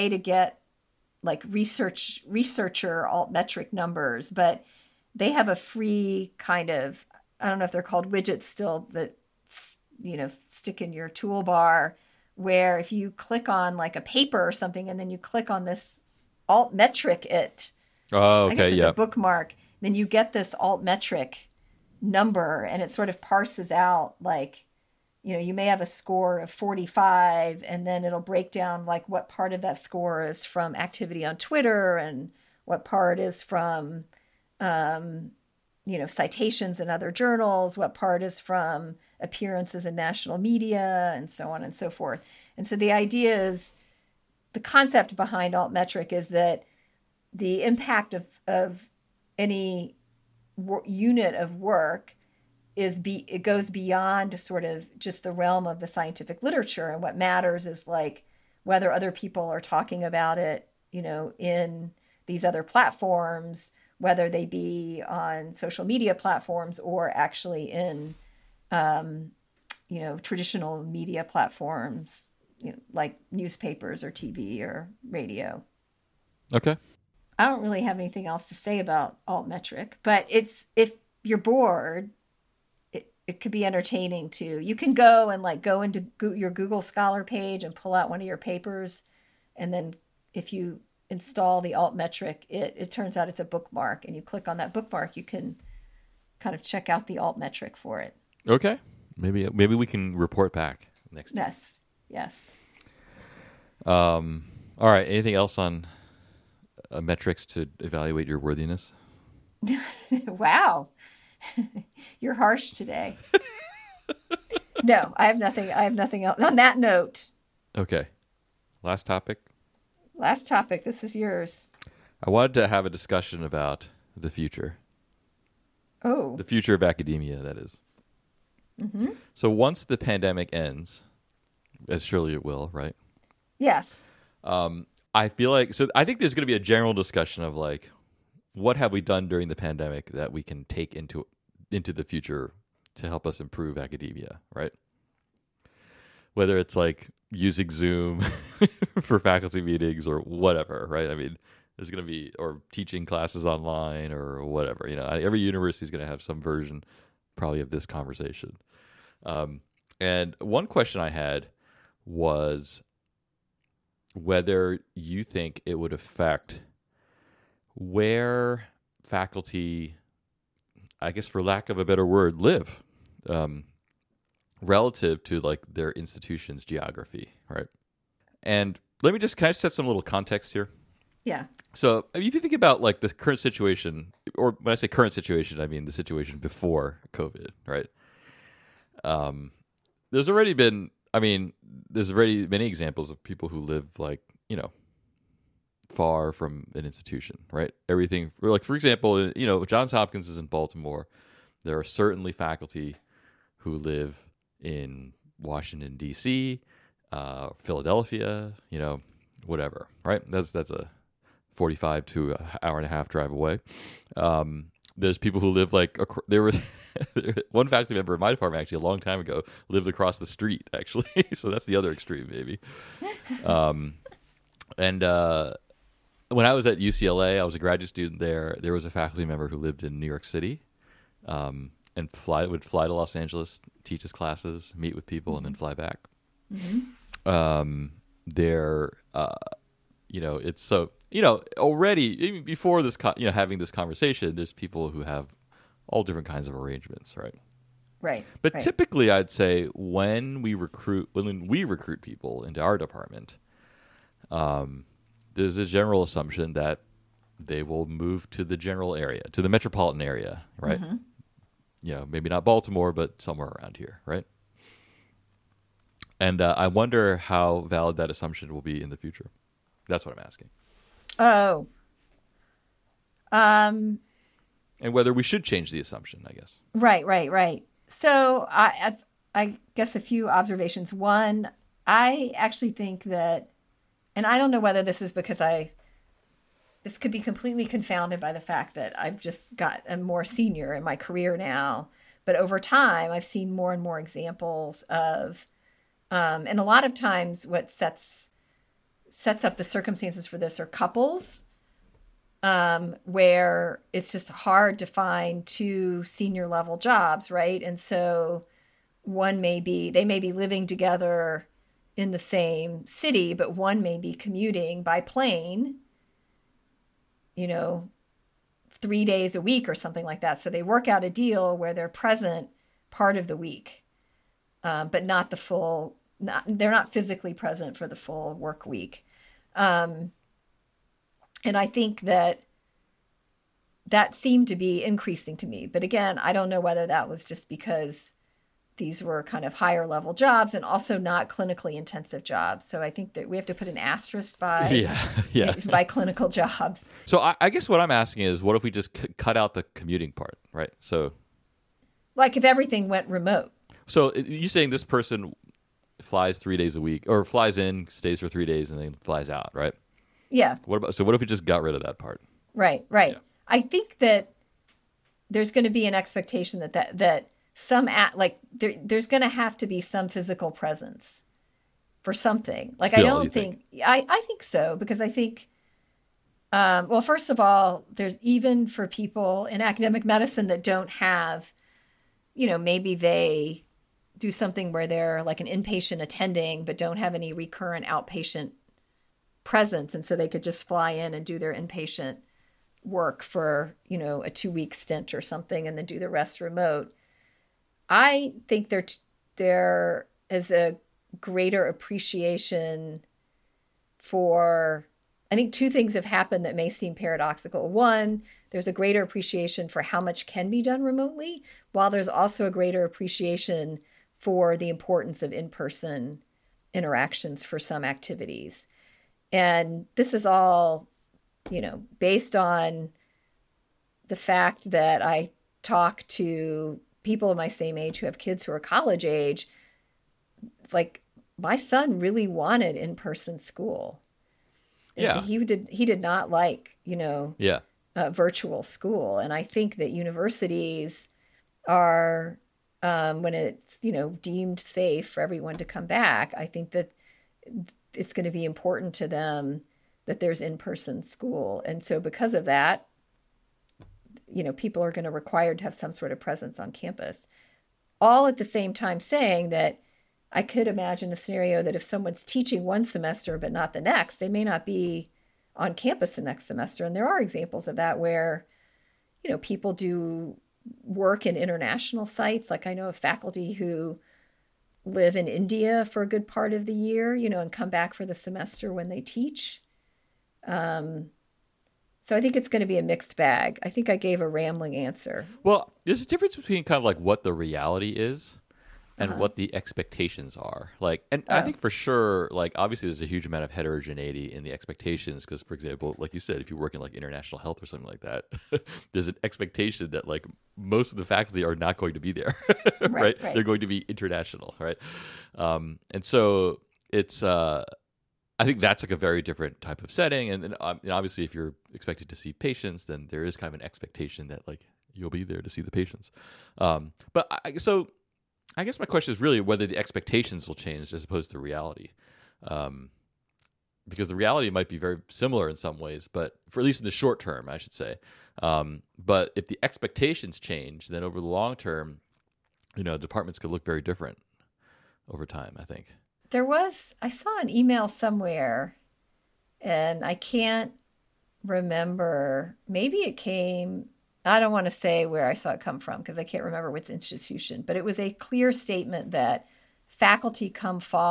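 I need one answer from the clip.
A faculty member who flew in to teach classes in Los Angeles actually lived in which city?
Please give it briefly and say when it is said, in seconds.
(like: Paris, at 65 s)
New York City, at 229 s.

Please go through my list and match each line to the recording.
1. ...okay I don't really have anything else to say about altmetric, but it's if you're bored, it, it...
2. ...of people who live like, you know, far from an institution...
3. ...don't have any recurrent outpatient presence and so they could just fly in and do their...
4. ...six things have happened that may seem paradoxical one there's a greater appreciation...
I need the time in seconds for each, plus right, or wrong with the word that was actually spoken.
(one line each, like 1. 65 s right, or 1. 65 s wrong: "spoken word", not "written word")
1. 76 s right
2. 193 s right
3. 386 s right
4. 405 s wrong: "two", not "six".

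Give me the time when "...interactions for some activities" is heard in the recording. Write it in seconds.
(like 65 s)
416 s.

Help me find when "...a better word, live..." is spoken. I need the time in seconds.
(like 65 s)
171 s.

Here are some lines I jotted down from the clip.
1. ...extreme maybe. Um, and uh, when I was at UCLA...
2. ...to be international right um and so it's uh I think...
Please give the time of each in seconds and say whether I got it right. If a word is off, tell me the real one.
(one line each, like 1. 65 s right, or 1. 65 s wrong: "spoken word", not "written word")
1. 221 s right
2. 503 s right.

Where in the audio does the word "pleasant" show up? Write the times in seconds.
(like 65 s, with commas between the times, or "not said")
not said.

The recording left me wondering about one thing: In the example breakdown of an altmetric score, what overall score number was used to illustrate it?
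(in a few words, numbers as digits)
45.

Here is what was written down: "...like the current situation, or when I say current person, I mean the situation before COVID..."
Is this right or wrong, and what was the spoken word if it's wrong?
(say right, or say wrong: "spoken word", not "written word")
wrong: "situation", not "person".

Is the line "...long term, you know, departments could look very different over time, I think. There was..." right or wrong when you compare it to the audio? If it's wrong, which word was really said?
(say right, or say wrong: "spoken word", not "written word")
right.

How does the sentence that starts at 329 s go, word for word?
Um, and I think that that seemed to be increasing to me.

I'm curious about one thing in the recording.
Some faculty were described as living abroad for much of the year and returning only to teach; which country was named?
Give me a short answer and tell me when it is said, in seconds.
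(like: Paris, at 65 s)
India, at 475 s.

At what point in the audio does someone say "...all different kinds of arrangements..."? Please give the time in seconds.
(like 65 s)
245 s.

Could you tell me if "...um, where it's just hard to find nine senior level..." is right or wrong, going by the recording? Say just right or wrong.
wrong.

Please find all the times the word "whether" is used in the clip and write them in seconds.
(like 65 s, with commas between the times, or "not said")
58 s, 63 s, 146 s, 164 s, 274 s, 284 s, 336 s, 519 s.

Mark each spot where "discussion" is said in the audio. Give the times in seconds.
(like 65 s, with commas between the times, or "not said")
122 s, 136 s.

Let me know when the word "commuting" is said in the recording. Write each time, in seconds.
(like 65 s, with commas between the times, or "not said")
314 s, 349 s.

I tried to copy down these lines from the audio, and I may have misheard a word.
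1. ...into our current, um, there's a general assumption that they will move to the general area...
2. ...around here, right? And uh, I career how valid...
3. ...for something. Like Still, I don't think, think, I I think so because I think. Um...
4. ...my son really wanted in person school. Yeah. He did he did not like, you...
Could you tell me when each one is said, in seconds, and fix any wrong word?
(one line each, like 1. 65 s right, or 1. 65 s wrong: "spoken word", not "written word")
1. 252 s wrong: "department", not "current"
2. 263 s wrong: "wonder", not "career"
3. 372 s right
4. 431 s right.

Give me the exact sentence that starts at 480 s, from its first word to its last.
Um, so I think it's going to be a mixed bag.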